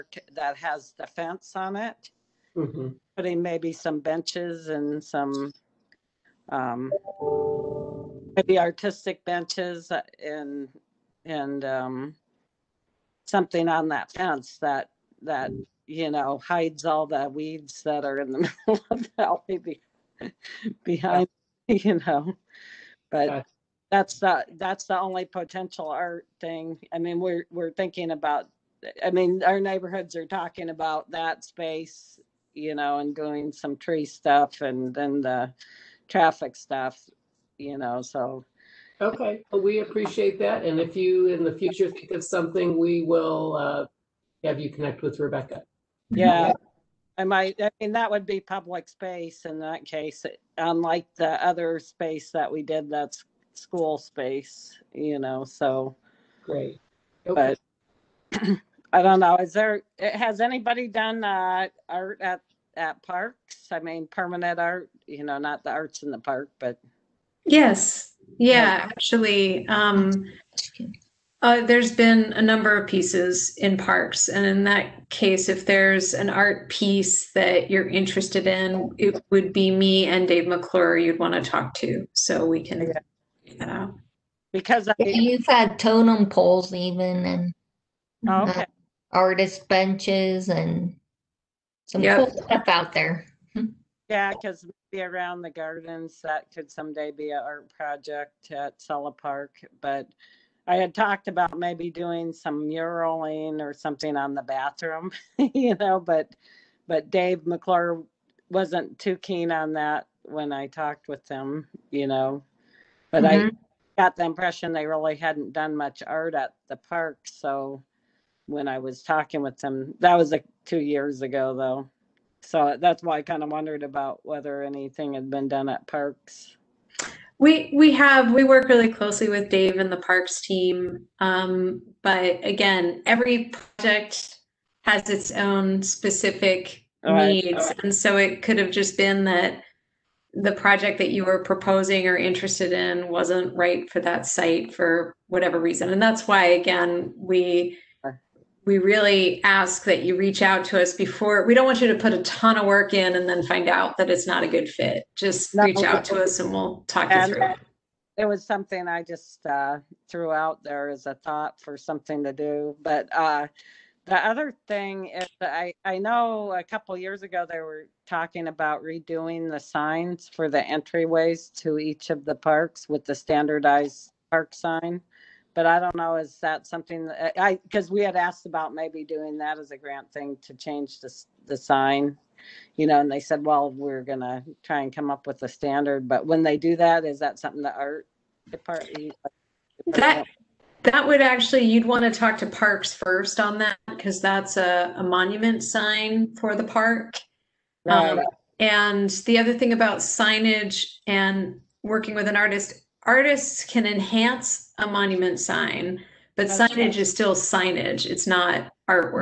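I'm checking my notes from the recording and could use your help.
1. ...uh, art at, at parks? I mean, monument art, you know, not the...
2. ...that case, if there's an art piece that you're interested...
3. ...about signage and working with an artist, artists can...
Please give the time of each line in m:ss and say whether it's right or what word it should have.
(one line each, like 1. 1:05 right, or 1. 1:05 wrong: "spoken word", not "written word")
1. 1:01 wrong: "permanent", not "monument"
2. 1:14 right
3. 3:19 right.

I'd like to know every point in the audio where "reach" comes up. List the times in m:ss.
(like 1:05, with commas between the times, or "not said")
2:30, 2:35.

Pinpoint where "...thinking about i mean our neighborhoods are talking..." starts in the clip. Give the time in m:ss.
0:27.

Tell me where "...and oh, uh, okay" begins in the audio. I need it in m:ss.
1:27.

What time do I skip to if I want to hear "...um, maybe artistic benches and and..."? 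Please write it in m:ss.
0:06.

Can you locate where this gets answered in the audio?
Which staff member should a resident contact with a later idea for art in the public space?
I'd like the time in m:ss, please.
0:45.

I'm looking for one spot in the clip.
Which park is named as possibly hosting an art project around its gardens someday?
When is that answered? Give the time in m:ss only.
1:38.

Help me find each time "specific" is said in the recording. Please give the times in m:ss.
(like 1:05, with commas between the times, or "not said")
2:15.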